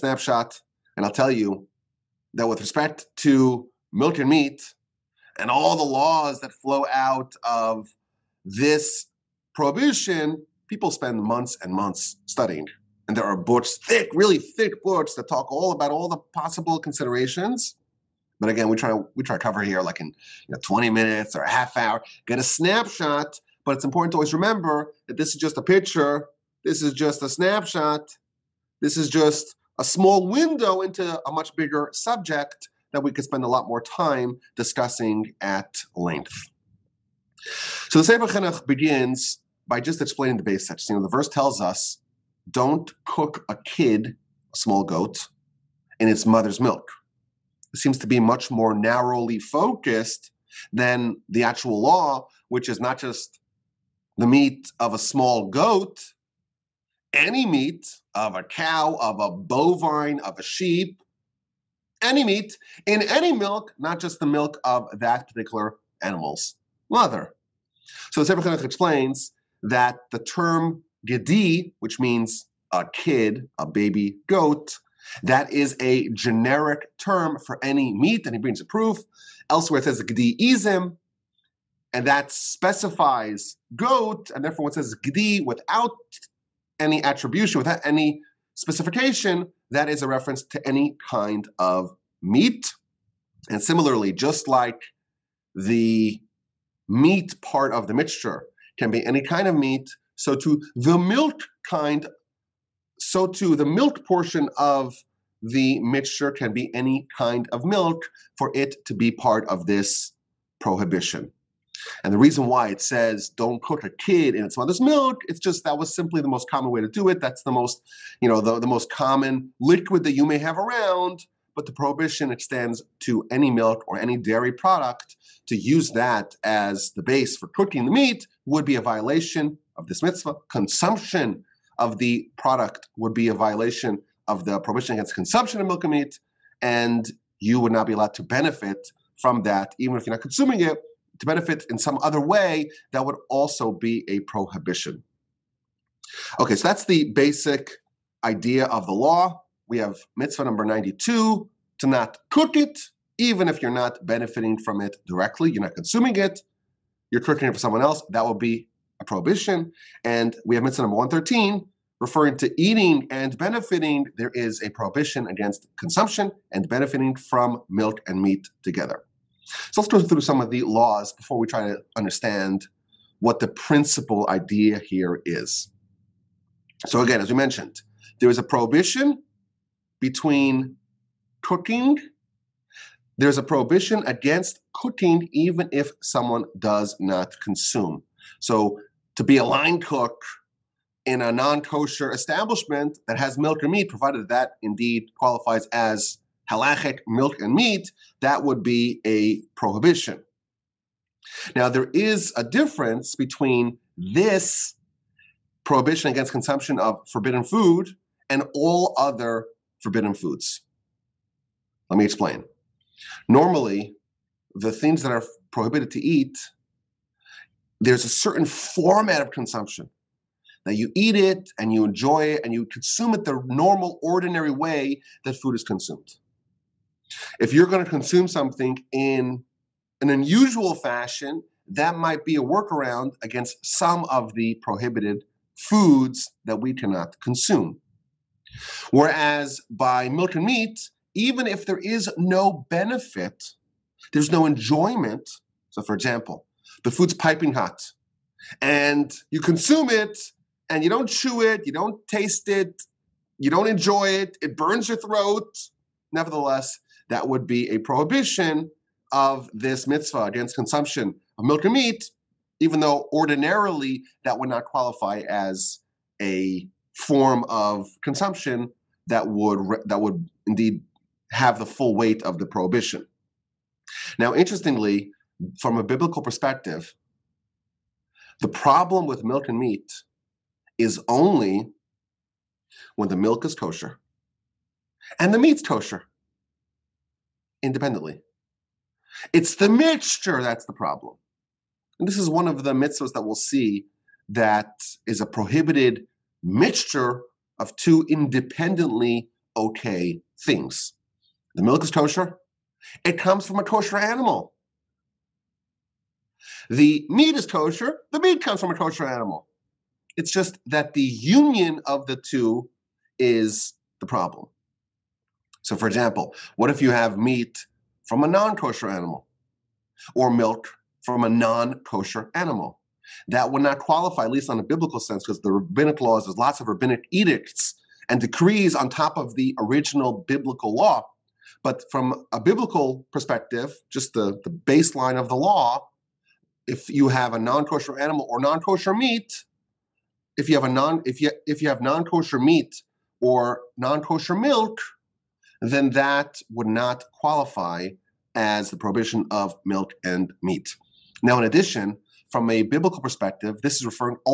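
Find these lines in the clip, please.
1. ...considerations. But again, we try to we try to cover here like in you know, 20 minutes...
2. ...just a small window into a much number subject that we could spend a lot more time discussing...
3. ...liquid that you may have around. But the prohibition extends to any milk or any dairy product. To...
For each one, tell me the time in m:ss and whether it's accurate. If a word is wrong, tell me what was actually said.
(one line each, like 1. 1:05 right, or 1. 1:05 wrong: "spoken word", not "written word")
1. 0:16 right
2. 0:29 wrong: "bigger", not "number"
3. 1:59 right.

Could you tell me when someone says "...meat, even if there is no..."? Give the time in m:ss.
4:00.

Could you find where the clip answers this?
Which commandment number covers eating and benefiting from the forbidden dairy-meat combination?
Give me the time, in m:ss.
2:40.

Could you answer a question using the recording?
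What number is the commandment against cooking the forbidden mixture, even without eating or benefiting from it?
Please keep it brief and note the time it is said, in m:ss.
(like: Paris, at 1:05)
92, at 2:30.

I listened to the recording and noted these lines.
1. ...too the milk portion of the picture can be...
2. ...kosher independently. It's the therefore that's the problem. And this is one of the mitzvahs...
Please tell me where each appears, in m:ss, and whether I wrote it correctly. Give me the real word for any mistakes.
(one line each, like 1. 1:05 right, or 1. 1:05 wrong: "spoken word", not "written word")
1. 1:43 wrong: "mixture", not "picture"
2. 4:45 wrong: "mixture", not "therefore".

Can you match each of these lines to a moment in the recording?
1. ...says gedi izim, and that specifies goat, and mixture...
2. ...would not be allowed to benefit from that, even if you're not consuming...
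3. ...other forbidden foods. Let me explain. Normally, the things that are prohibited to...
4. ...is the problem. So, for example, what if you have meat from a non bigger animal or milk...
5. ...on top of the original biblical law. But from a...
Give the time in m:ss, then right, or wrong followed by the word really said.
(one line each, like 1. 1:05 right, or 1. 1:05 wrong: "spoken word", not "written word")
1. 1:19 wrong: "therefore", not "mixture"
2. 2:17 right
3. 3:28 right
4. 5:13 wrong: "kosher", not "bigger"
5. 5:28 right.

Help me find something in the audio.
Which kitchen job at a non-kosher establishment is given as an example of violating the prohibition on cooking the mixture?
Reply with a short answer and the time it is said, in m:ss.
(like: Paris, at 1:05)
line cook, at 3:09.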